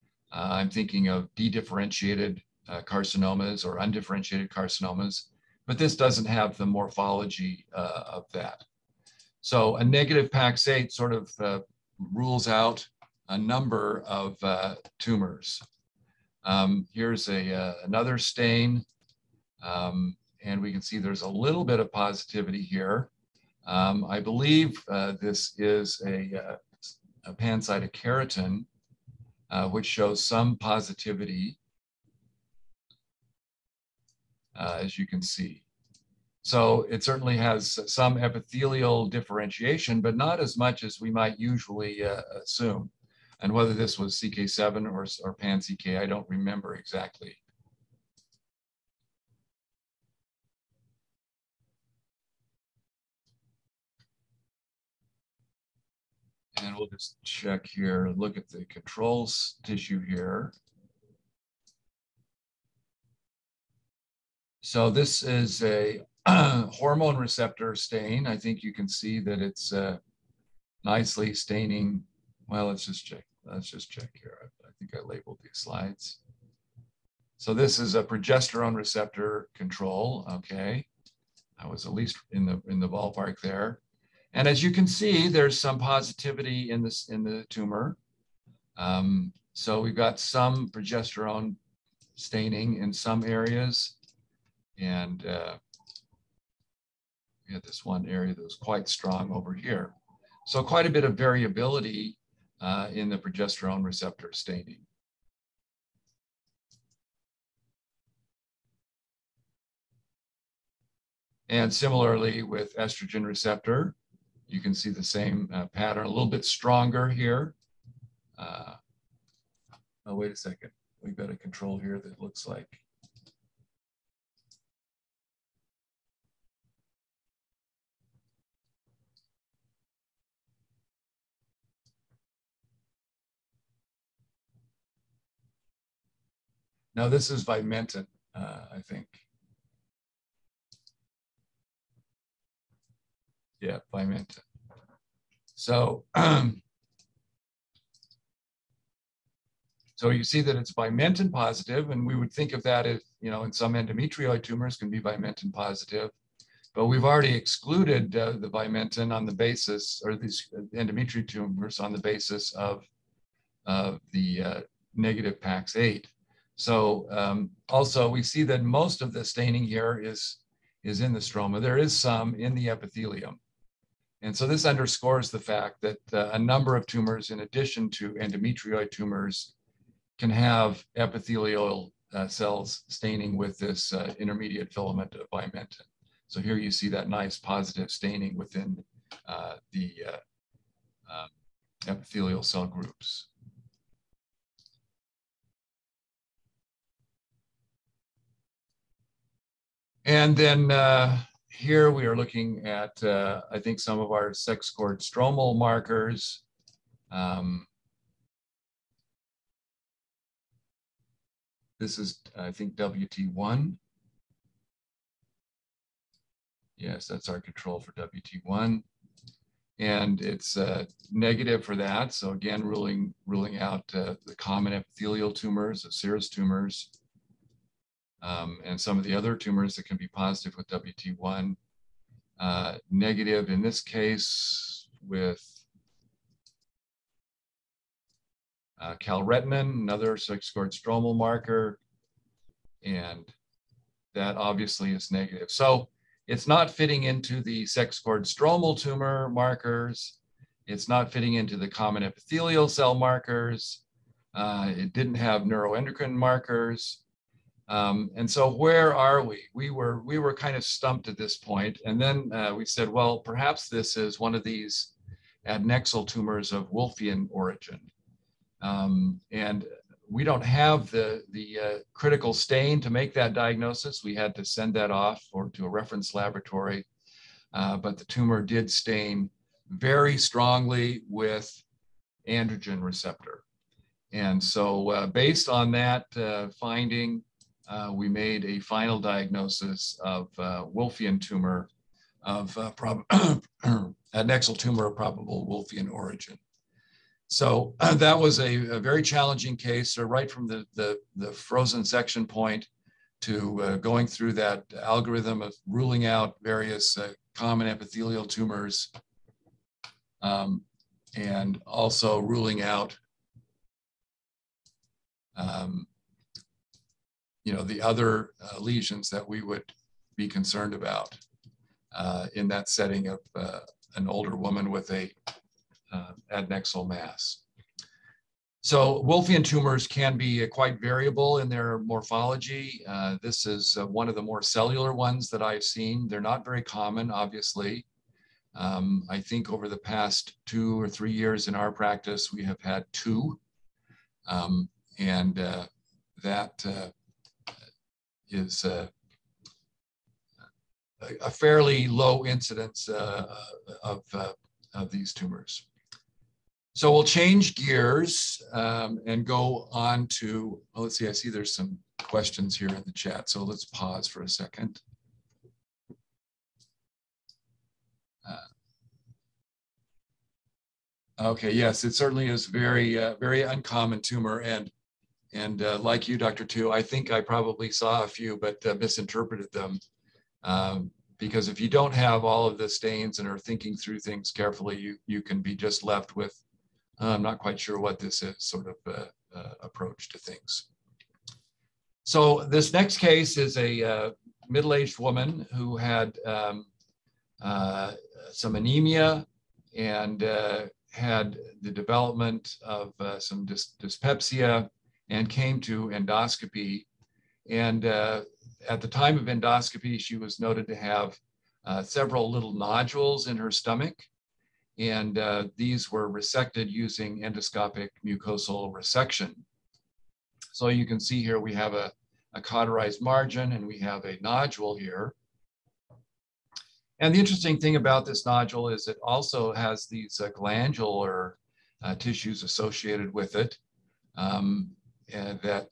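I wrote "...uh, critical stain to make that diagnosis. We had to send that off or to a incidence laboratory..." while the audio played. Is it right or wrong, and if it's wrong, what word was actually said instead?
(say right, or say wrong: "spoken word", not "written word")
wrong: "reference", not "incidence".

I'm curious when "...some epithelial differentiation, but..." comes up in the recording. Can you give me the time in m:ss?
0:37.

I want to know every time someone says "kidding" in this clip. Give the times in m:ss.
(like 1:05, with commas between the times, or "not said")
not said.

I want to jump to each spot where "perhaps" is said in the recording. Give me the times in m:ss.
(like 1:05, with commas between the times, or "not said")
4:23.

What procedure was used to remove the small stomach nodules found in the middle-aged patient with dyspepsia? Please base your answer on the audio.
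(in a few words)
Endoscopic mucosal resection.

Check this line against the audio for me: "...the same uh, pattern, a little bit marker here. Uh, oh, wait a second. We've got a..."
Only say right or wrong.
wrong.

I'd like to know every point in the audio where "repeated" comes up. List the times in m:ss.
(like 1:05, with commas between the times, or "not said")
not said.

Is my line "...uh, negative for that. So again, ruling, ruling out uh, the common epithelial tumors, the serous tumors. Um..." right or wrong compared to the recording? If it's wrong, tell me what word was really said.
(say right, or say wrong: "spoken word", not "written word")
right.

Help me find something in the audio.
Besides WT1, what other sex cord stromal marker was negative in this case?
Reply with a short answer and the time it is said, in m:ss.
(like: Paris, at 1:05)
Calretinin, at 3:58.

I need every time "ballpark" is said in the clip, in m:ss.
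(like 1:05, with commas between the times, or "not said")
1:22.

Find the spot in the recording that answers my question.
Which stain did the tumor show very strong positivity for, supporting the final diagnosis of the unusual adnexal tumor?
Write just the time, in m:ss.
4:42.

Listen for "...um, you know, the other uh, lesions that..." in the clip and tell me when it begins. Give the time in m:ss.
5:15.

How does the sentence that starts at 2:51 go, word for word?
There is some in the epithelium.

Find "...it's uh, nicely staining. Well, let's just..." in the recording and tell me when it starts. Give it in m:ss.
1:09.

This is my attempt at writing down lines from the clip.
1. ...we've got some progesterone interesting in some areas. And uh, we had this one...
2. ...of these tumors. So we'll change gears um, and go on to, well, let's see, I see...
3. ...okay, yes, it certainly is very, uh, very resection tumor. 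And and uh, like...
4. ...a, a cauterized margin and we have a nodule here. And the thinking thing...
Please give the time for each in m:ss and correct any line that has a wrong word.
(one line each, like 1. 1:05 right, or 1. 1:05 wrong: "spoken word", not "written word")
1. 1:29 wrong: "staining", not "interesting"
2. 5:54 right
3. 6:11 wrong: "uncommon", not "resection"
4. 7:01 wrong: "interesting", not "thinking".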